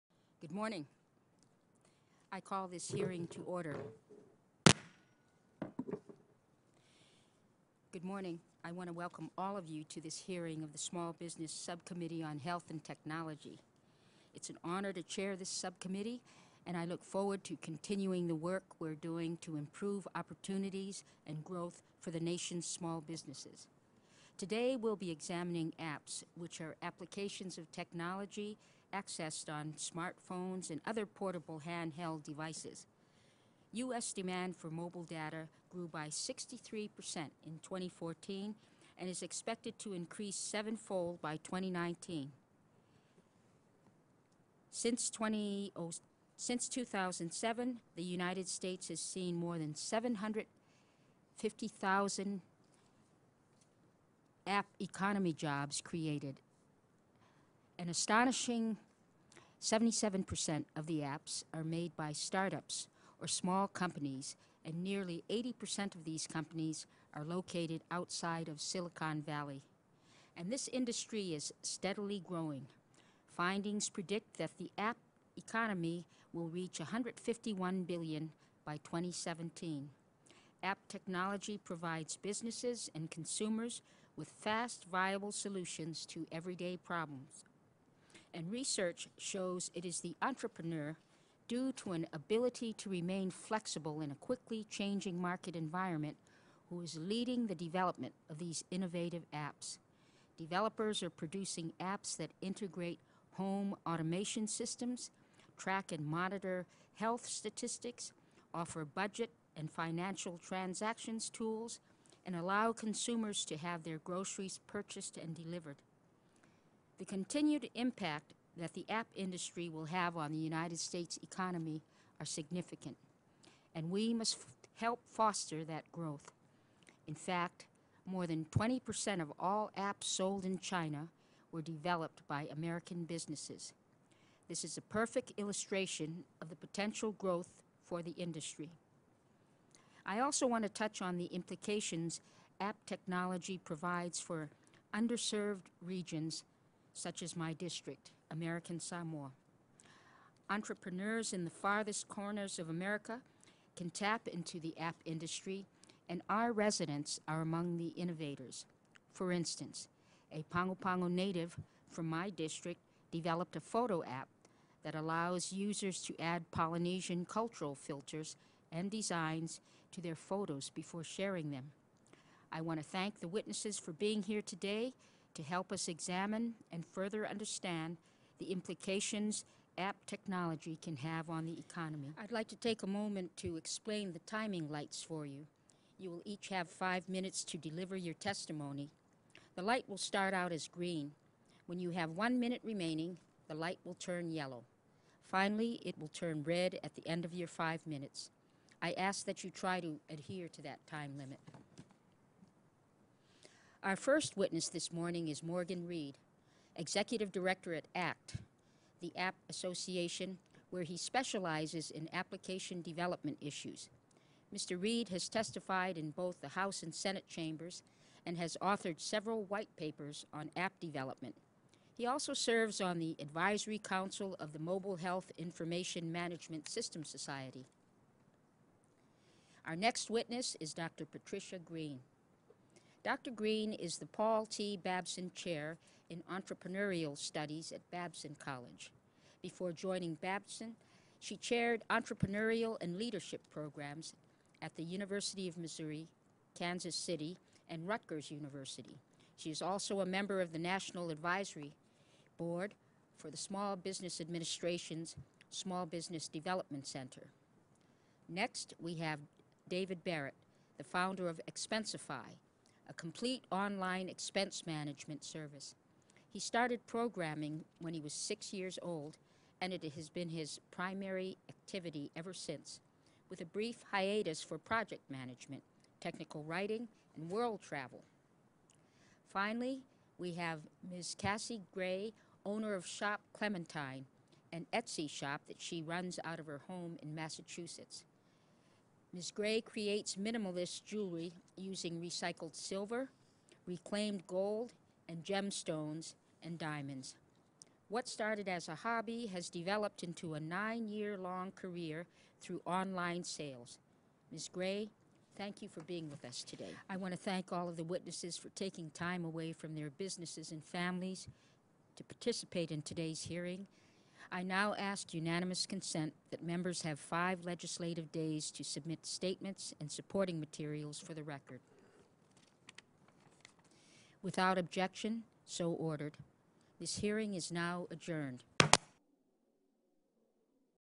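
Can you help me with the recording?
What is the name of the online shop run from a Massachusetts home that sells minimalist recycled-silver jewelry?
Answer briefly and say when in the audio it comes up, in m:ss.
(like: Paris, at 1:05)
Shop Clementine, at 4:42.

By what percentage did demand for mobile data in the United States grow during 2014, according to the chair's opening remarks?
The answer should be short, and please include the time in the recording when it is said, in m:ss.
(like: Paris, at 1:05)
63%, at 0:36.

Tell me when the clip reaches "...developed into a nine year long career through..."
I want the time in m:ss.
4:59.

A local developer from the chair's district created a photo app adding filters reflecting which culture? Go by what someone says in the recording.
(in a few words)
Polynesian.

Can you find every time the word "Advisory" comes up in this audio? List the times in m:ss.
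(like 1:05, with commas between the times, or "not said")
3:43, 4:11.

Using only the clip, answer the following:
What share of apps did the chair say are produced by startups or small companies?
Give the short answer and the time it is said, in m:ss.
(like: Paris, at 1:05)
77%, at 0:59.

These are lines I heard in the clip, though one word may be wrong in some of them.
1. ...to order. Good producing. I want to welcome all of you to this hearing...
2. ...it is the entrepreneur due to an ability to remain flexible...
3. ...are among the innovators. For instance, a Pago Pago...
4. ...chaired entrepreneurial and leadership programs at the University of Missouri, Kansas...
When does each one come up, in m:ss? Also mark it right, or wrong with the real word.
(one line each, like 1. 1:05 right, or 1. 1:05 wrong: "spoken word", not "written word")
1. 0:03 wrong: "morning", not "producing"
2. 1:29 right
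3. 2:37 right
4. 4:01 right.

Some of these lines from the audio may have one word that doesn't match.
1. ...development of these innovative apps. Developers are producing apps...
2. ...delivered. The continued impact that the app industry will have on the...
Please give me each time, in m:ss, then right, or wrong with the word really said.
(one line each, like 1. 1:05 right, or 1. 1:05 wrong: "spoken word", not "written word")
1. 1:37 right
2. 1:55 right.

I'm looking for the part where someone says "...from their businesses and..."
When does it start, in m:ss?
5:09.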